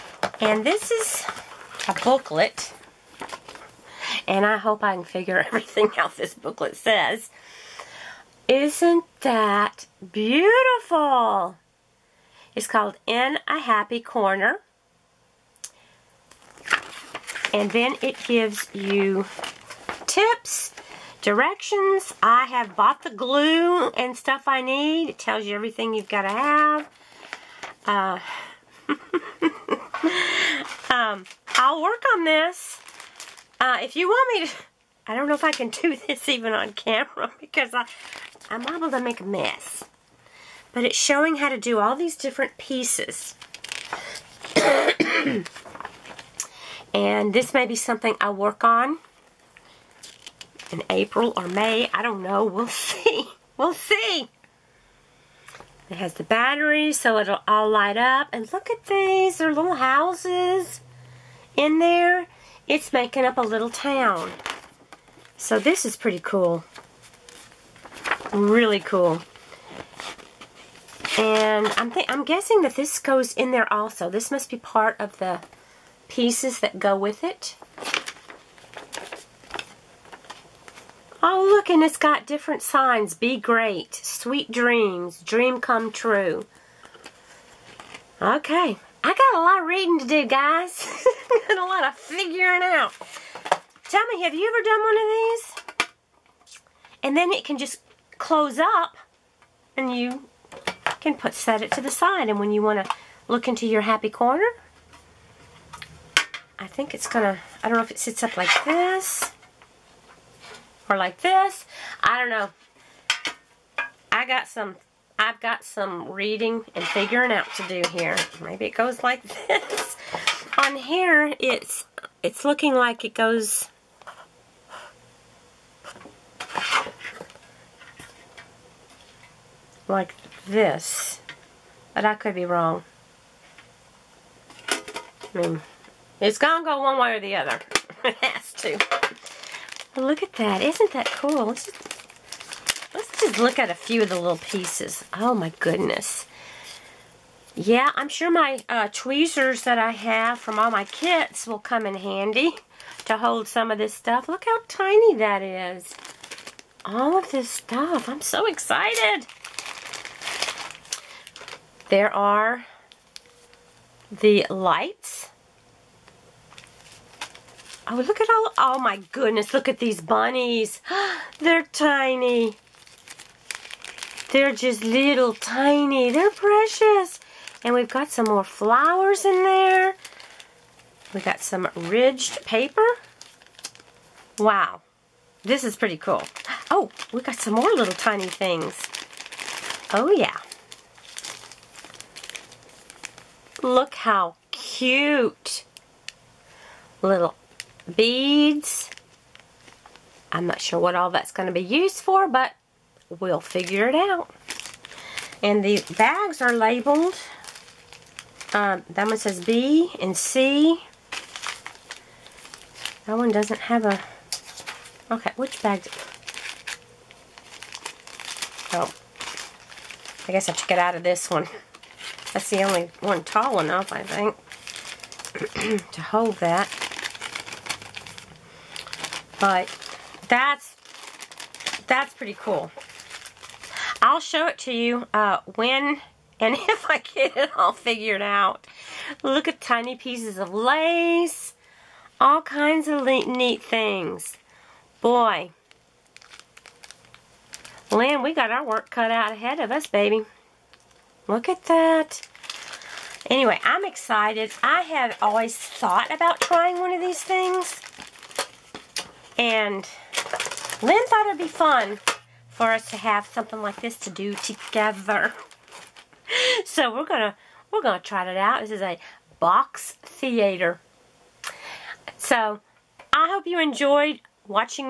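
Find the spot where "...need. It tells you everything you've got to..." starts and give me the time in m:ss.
0:24.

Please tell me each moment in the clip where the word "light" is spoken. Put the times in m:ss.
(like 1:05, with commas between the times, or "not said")
0:57, 2:44.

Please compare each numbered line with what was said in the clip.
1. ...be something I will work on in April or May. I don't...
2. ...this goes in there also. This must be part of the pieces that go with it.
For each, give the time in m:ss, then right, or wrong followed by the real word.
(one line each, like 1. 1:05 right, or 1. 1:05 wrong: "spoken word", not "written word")
1. 0:47 right
2. 1:12 right.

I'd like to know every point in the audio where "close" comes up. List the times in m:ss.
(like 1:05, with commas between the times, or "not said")
1:38.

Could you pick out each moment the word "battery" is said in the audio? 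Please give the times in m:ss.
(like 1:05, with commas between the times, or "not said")
0:56.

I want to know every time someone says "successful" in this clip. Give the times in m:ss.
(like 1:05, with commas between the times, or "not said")
not said.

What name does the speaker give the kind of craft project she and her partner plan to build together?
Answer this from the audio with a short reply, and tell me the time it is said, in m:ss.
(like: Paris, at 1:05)
box theater, at 4:29.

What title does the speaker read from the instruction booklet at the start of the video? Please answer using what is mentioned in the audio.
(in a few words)
In a Happy Corner.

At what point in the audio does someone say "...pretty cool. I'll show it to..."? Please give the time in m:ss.
3:52.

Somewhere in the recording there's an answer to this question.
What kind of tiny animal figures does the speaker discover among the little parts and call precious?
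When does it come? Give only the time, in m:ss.
2:50.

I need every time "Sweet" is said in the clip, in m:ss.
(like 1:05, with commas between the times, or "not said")
1:23.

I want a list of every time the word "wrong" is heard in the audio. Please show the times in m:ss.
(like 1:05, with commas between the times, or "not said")
2:12.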